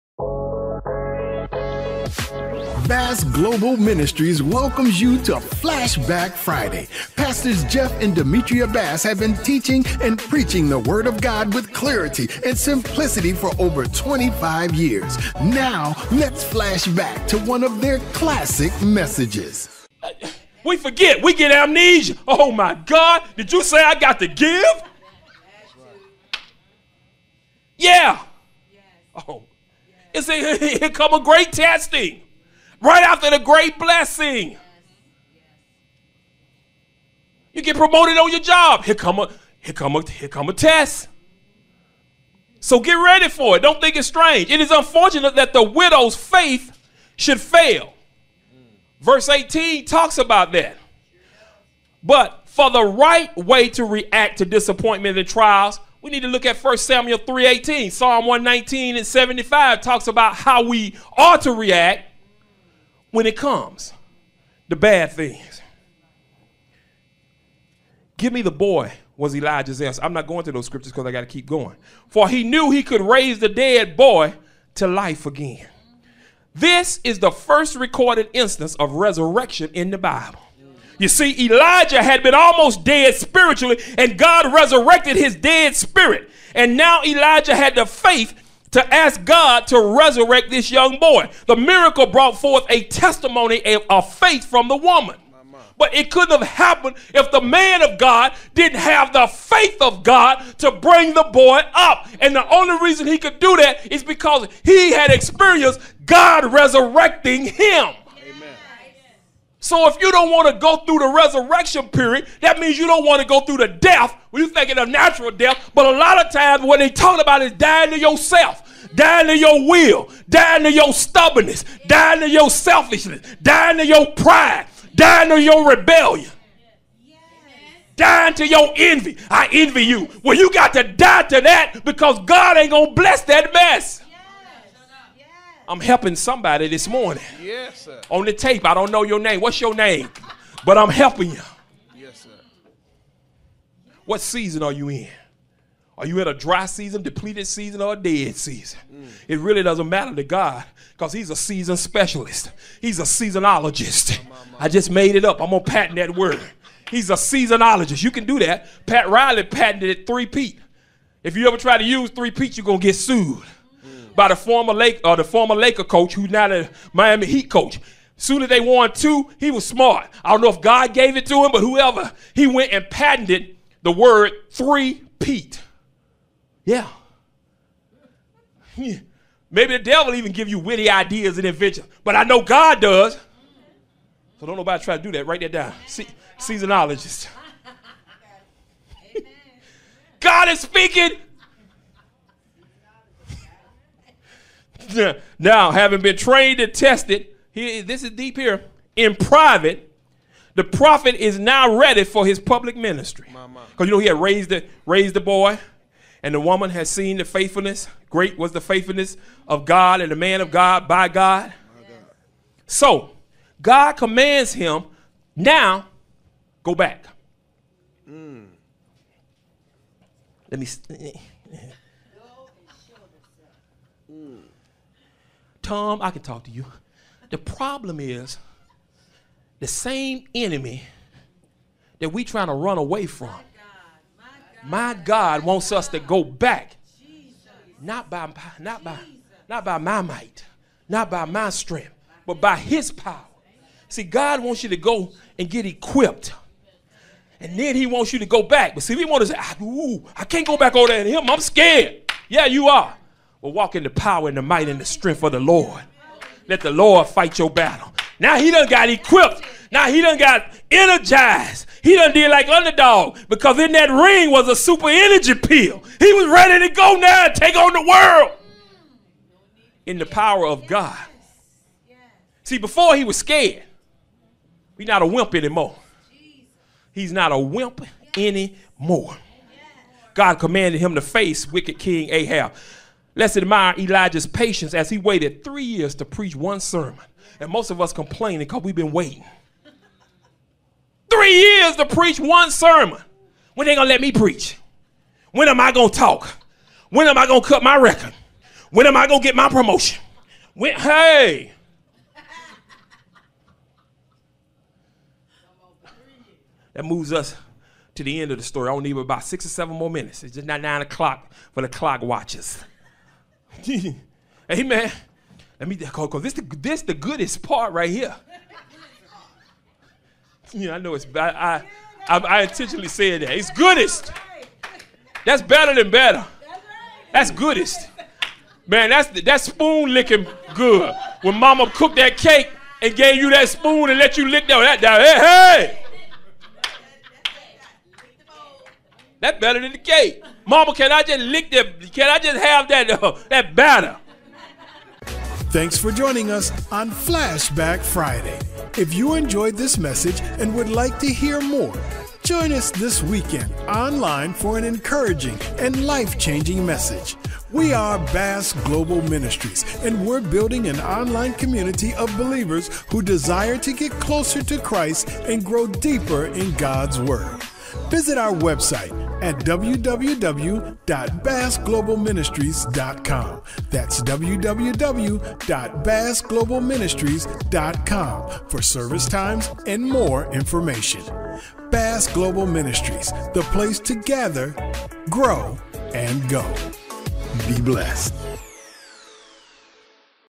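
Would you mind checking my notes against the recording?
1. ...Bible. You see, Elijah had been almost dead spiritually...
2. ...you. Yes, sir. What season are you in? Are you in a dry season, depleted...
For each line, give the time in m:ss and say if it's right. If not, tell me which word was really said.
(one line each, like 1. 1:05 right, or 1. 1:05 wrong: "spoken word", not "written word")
1. 1:19 right
2. 2:21 right.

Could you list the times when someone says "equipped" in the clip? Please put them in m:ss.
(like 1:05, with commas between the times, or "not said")
4:05, 4:18.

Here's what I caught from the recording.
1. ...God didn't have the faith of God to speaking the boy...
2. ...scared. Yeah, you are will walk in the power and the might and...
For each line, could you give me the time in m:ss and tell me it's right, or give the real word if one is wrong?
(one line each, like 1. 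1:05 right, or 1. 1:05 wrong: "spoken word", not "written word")
1. 1:37 wrong: "bring", not "speaking"
2. 4:11 right.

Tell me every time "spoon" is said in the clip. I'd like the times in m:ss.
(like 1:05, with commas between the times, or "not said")
5:29, 5:33.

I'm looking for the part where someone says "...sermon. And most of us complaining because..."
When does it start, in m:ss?
4:46.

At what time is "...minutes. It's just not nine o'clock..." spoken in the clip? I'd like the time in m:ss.
5:09.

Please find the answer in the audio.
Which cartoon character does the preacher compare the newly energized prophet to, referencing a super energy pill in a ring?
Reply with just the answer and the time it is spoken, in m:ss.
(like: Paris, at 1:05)
Underdog, at 4:22.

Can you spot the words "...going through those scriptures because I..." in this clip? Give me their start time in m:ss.
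1:10.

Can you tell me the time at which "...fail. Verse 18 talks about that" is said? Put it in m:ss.
0:47.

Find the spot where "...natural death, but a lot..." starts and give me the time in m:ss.
1:54.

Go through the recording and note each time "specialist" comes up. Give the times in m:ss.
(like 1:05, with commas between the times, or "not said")
2:31.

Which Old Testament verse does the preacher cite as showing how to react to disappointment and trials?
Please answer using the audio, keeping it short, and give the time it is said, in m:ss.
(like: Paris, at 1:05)
1 Samuel 3:18, at 0:56.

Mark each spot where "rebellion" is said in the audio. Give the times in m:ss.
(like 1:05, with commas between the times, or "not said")
2:05.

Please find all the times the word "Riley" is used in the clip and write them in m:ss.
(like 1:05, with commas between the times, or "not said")
2:39.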